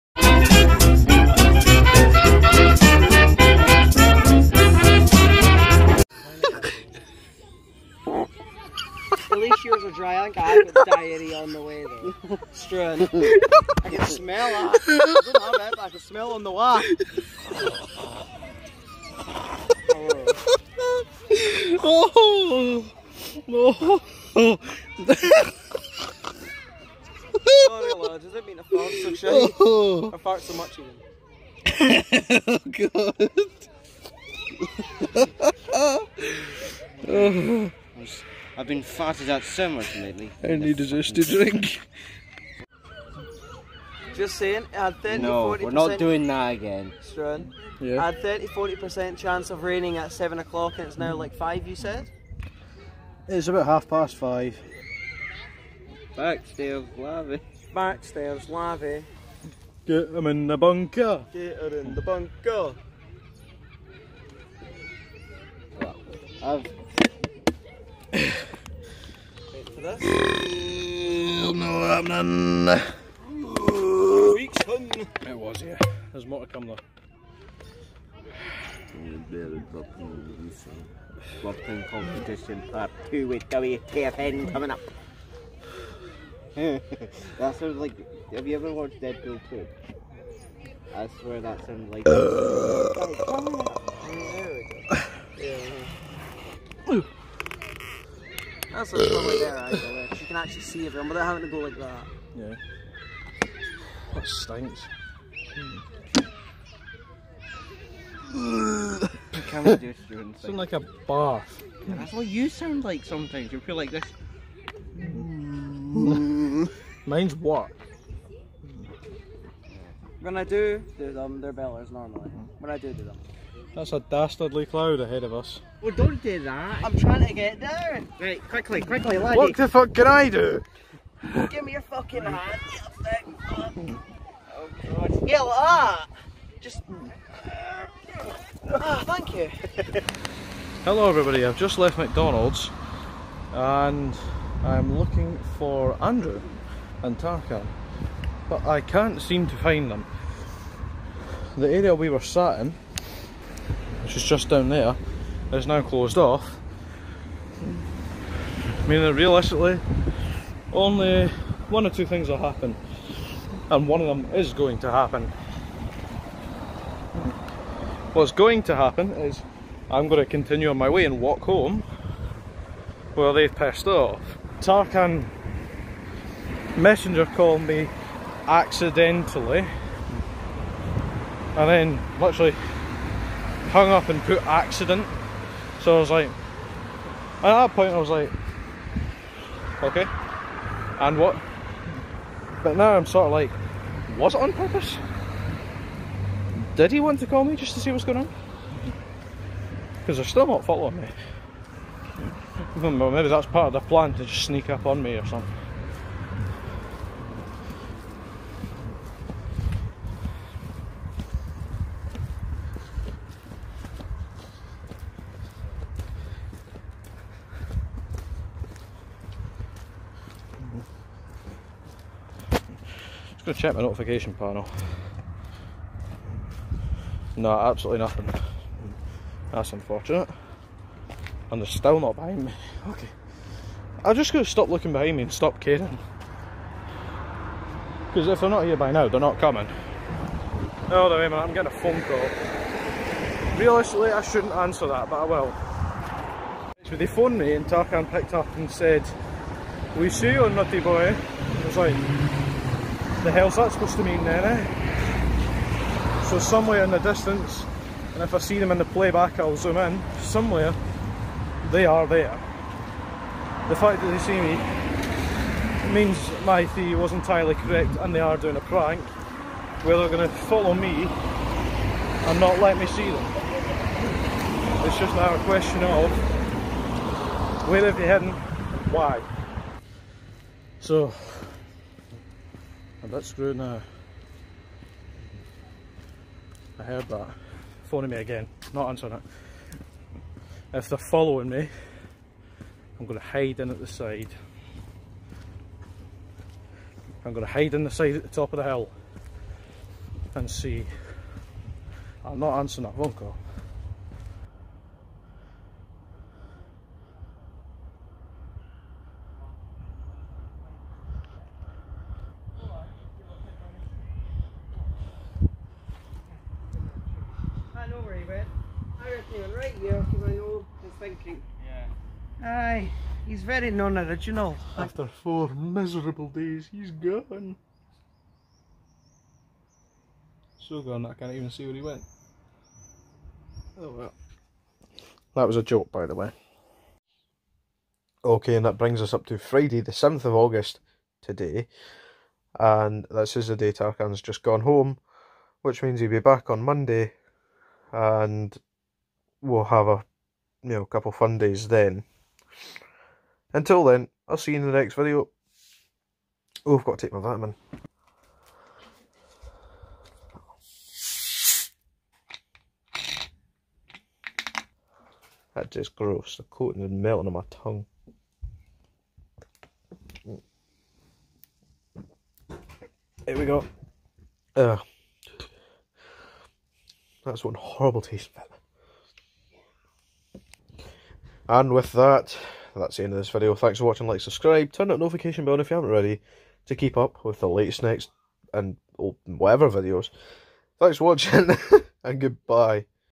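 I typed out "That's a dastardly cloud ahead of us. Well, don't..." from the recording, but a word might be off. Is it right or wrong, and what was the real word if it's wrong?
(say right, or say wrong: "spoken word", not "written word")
right.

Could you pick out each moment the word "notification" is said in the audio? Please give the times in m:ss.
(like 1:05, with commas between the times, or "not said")
3:43, 6:24.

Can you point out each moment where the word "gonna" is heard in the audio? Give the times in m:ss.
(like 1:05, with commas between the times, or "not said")
3:43, 3:54.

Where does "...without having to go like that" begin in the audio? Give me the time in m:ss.
1:41.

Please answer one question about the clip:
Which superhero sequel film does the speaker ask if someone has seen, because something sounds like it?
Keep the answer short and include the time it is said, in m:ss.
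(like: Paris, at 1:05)
Deadpool 2, at 1:29.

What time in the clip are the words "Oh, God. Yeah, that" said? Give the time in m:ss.
2:14.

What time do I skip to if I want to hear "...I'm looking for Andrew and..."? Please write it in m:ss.
2:24.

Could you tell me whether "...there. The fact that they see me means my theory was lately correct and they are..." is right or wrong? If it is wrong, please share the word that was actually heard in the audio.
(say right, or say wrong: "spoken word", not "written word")
wrong: "entirely", not "lately".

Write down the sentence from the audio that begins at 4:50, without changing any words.
If they're following me, I'm going to hide in at the side.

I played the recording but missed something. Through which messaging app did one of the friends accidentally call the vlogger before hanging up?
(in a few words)
Messenger.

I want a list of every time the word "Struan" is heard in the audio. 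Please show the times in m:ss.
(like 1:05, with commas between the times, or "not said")
0:12, 0:47.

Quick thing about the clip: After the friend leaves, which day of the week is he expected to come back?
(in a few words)
Monday.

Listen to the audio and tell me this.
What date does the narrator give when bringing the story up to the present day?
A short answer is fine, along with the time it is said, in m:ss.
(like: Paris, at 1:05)
Friday, 7 August, at 5:39.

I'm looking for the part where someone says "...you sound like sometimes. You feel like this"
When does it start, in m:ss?
1:52.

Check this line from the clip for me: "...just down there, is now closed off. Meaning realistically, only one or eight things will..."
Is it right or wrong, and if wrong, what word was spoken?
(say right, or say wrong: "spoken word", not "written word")
wrong: "two", not "eight".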